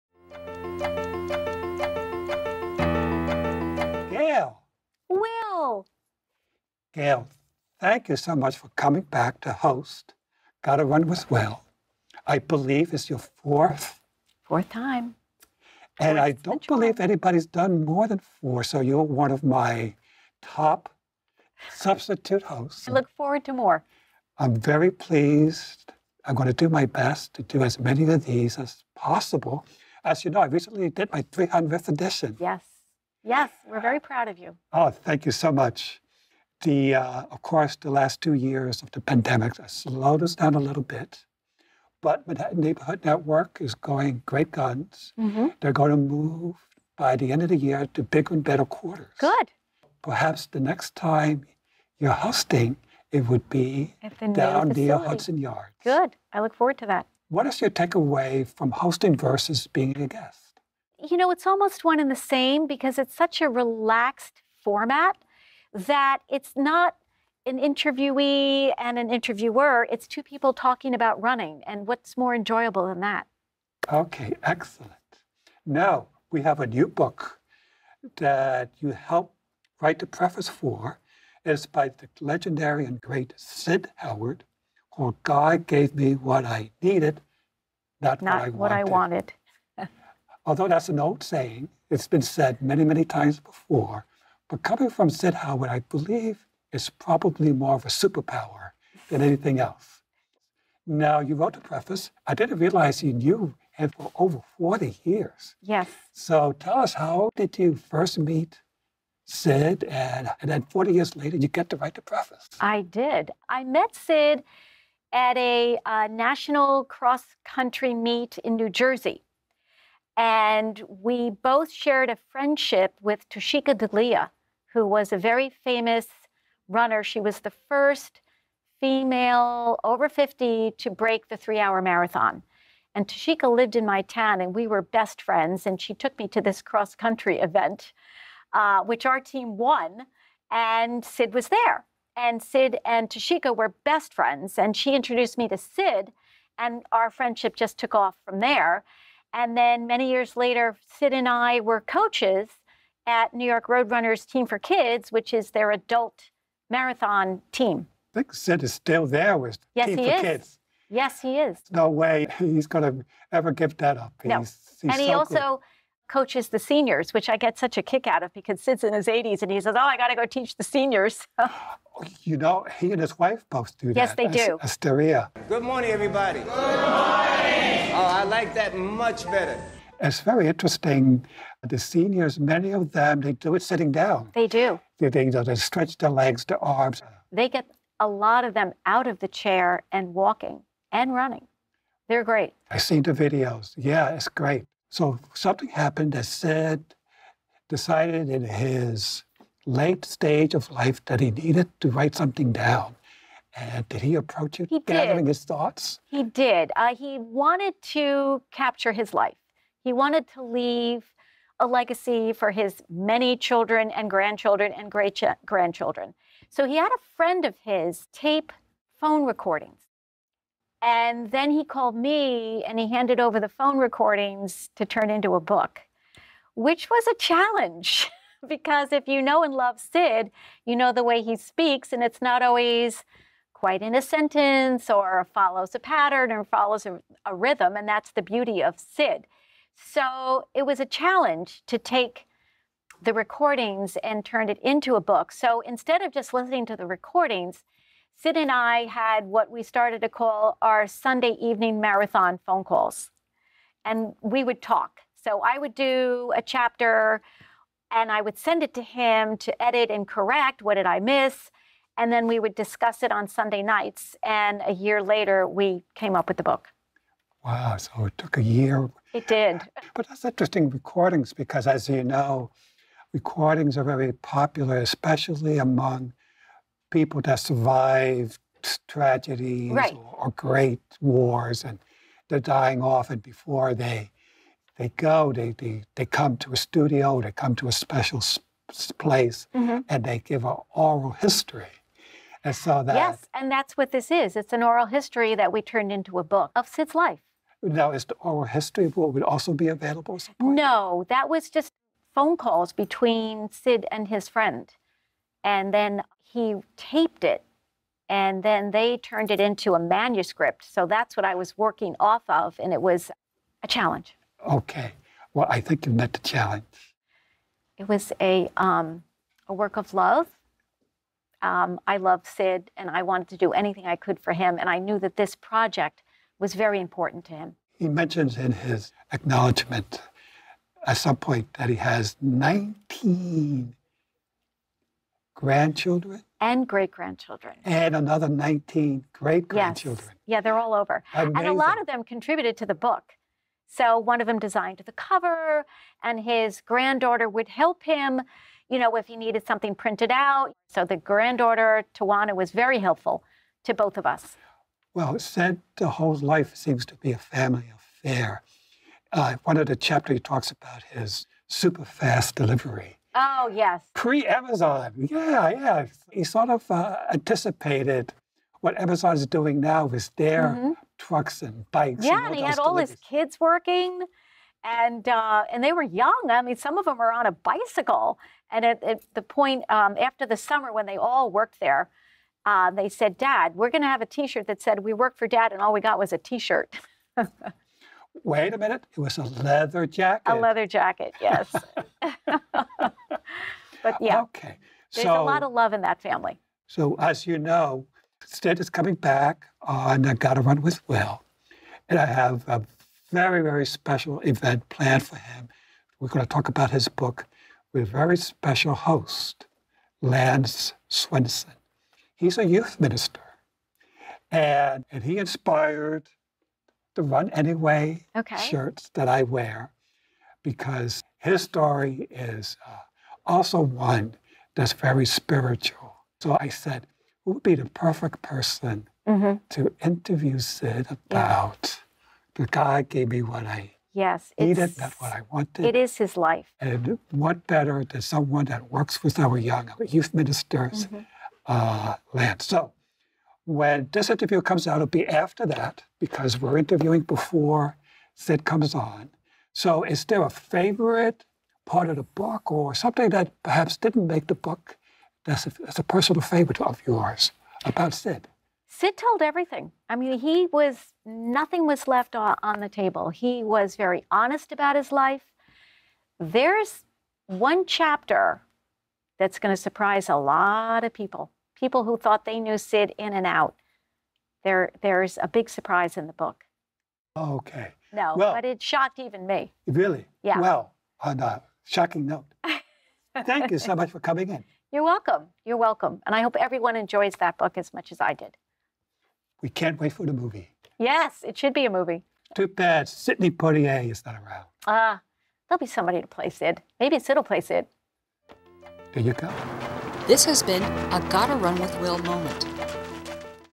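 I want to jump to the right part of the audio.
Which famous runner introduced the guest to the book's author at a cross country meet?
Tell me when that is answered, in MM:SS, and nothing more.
02:03.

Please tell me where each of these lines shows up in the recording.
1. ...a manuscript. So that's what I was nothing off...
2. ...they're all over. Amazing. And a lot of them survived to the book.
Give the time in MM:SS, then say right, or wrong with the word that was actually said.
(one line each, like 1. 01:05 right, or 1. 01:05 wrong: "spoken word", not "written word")
1. 05:09 wrong: "working", not "nothing"
2. 05:40 wrong: "contributed", not "survived".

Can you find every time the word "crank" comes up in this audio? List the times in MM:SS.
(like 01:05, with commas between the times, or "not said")
not said.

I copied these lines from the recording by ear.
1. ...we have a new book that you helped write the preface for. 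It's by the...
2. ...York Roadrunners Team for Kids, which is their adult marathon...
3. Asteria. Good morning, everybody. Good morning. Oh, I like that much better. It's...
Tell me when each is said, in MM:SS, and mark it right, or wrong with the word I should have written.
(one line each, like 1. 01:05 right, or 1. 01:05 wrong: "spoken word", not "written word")
1. 01:16 right
2. 02:33 right
3. 02:54 right.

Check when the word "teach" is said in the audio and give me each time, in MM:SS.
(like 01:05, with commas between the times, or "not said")
02:50.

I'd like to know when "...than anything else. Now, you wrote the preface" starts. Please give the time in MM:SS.
01:39.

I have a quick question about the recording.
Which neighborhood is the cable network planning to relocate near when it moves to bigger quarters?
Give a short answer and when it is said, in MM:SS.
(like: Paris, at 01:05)
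Hudson Yards, at 00:54.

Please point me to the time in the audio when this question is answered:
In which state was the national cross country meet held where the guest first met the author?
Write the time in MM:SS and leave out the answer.
01:58.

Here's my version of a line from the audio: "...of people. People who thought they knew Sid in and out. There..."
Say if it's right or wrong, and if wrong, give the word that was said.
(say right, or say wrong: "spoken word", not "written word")
right.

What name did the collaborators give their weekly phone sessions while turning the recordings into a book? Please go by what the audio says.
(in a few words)
Sunday evening marathon phone calls.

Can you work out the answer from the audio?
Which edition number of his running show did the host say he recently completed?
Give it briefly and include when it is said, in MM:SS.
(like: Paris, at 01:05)
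300th, at 00:31.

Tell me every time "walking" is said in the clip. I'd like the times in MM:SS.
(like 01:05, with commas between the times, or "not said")
03:10.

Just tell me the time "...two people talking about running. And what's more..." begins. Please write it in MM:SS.
01:10.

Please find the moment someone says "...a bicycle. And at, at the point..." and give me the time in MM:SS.
06:17.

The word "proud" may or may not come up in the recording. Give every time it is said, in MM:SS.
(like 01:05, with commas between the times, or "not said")
00:34.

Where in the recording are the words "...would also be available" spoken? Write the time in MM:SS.
04:59.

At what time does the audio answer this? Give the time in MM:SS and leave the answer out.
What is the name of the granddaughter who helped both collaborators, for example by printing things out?
05:51.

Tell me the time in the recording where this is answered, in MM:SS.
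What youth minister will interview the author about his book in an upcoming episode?
06:50.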